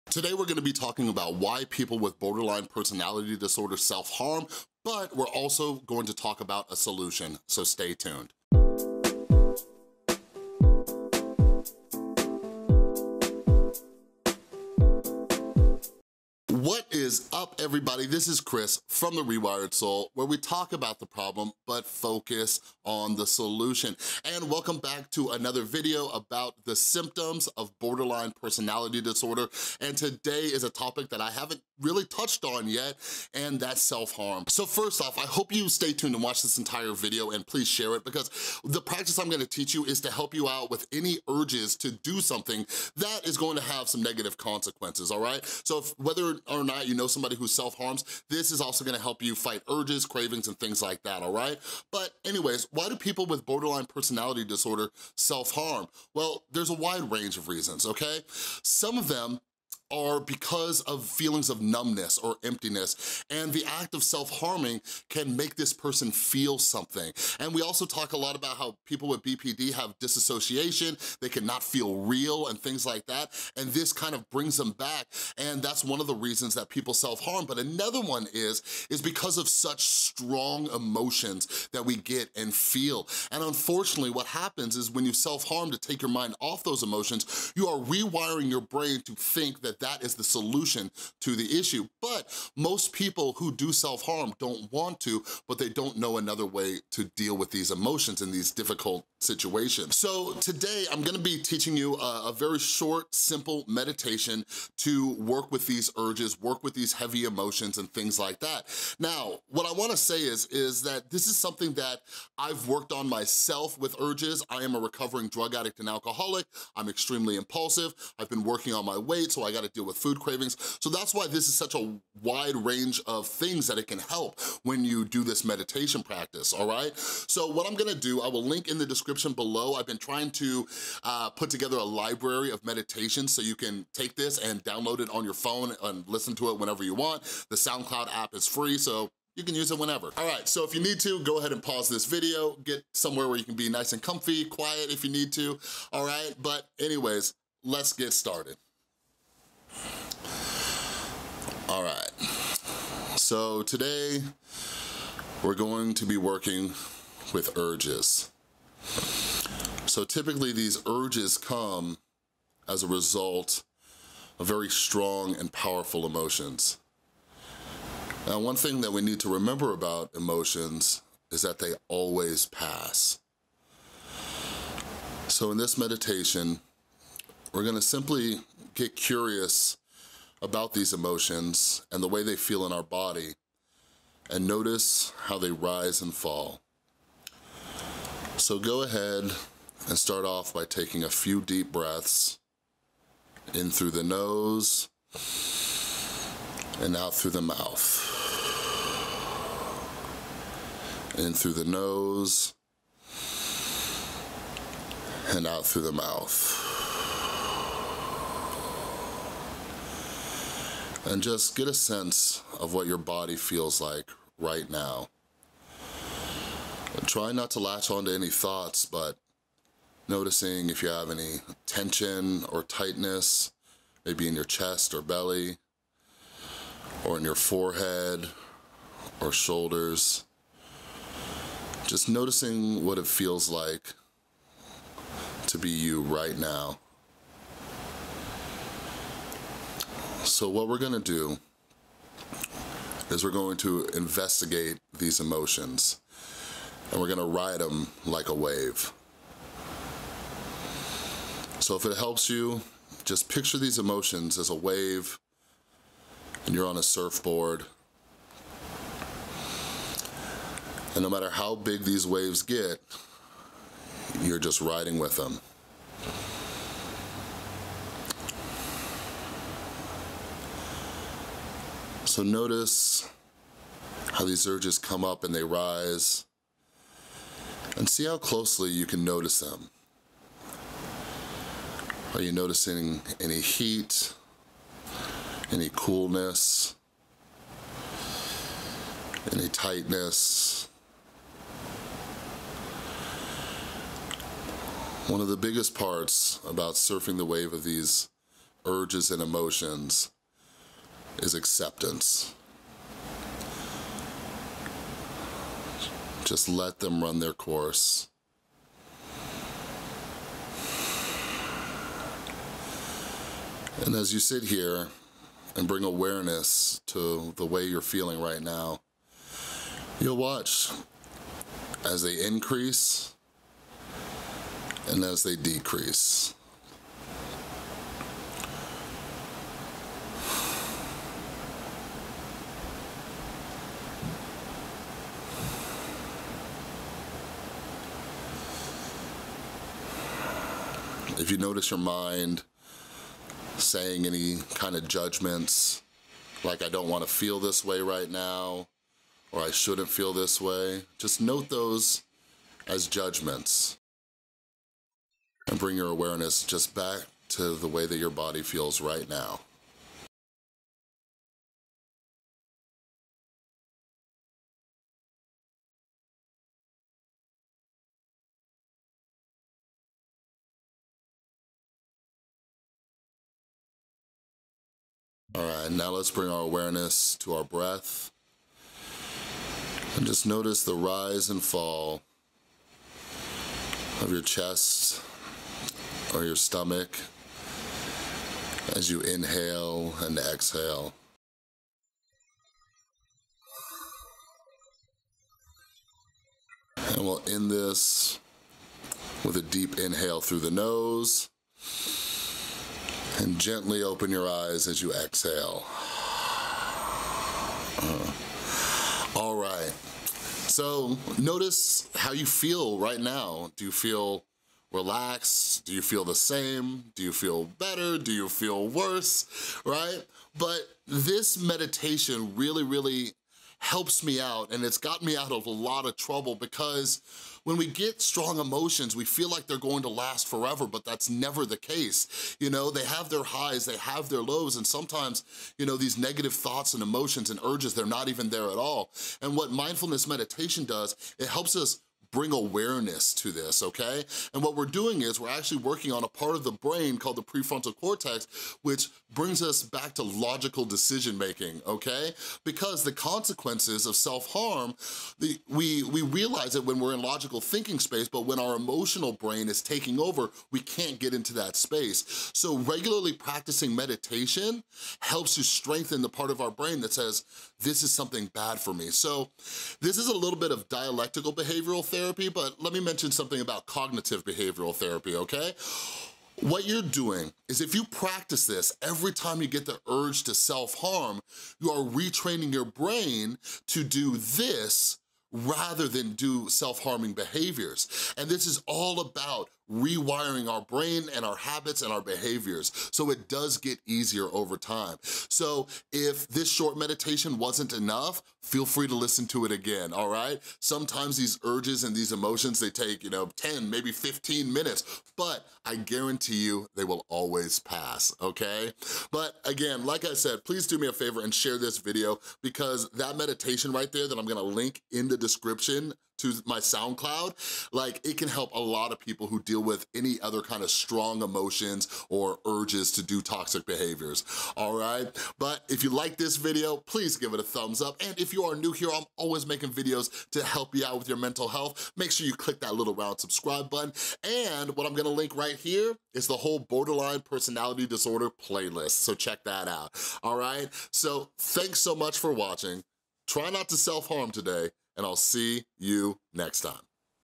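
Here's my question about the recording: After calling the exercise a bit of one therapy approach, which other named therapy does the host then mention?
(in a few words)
cognitive behavioral therapy.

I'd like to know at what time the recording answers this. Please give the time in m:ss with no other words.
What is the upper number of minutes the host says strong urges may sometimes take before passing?
8:23.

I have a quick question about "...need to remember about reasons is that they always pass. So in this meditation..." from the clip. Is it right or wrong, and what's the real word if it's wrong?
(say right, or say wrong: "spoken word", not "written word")
wrong: "emotions", not "reasons".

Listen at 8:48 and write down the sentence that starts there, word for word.
And if you are new here, I'm always making videos to help you out with your mental health.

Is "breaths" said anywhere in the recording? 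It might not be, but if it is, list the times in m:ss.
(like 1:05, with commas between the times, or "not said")
3:11, 6:17.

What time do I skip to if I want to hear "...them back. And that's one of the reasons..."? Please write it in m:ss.
1:14.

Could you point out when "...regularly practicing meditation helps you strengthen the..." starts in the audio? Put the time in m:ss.
7:42.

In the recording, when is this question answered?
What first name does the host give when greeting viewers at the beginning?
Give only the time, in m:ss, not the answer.
0:18.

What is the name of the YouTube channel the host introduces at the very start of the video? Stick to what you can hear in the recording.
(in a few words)
The Rewired Soul.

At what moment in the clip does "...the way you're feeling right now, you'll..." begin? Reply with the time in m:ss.
5:17.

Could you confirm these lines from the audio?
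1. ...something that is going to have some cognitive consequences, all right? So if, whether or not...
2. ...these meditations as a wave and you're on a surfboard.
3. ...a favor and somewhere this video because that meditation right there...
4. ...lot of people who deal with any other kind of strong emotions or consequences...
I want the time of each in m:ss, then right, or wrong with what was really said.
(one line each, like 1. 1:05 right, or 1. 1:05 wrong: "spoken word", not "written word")
1. 0:42 wrong: "negative", not "cognitive"
2. 4:13 wrong: "emotions", not "meditations"
3. 8:30 wrong: "share", not "somewhere"
4. 8:38 wrong: "urges", not "consequences".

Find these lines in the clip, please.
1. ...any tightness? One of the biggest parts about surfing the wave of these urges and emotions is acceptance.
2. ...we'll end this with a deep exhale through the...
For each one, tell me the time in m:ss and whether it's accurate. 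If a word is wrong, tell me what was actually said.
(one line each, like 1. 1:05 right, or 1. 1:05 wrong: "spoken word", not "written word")
1. 4:49 right
2. 6:37 wrong: "inhale", not "exhale".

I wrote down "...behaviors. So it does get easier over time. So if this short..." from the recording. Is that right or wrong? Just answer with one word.
right.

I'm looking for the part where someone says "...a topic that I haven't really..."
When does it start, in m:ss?
0:30.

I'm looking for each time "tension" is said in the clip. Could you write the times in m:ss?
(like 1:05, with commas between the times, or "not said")
3:41.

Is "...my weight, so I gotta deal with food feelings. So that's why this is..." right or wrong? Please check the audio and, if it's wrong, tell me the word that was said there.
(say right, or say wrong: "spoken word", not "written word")
wrong: "cravings", not "feelings".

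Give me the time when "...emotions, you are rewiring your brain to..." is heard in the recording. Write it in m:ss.
1:26.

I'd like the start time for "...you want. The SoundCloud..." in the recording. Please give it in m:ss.
2:16.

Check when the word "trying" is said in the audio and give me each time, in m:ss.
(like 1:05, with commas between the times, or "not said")
2:09.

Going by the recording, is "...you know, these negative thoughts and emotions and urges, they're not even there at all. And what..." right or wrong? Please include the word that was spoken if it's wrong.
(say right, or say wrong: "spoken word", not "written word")
right.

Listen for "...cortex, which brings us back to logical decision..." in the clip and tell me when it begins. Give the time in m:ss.
7:27.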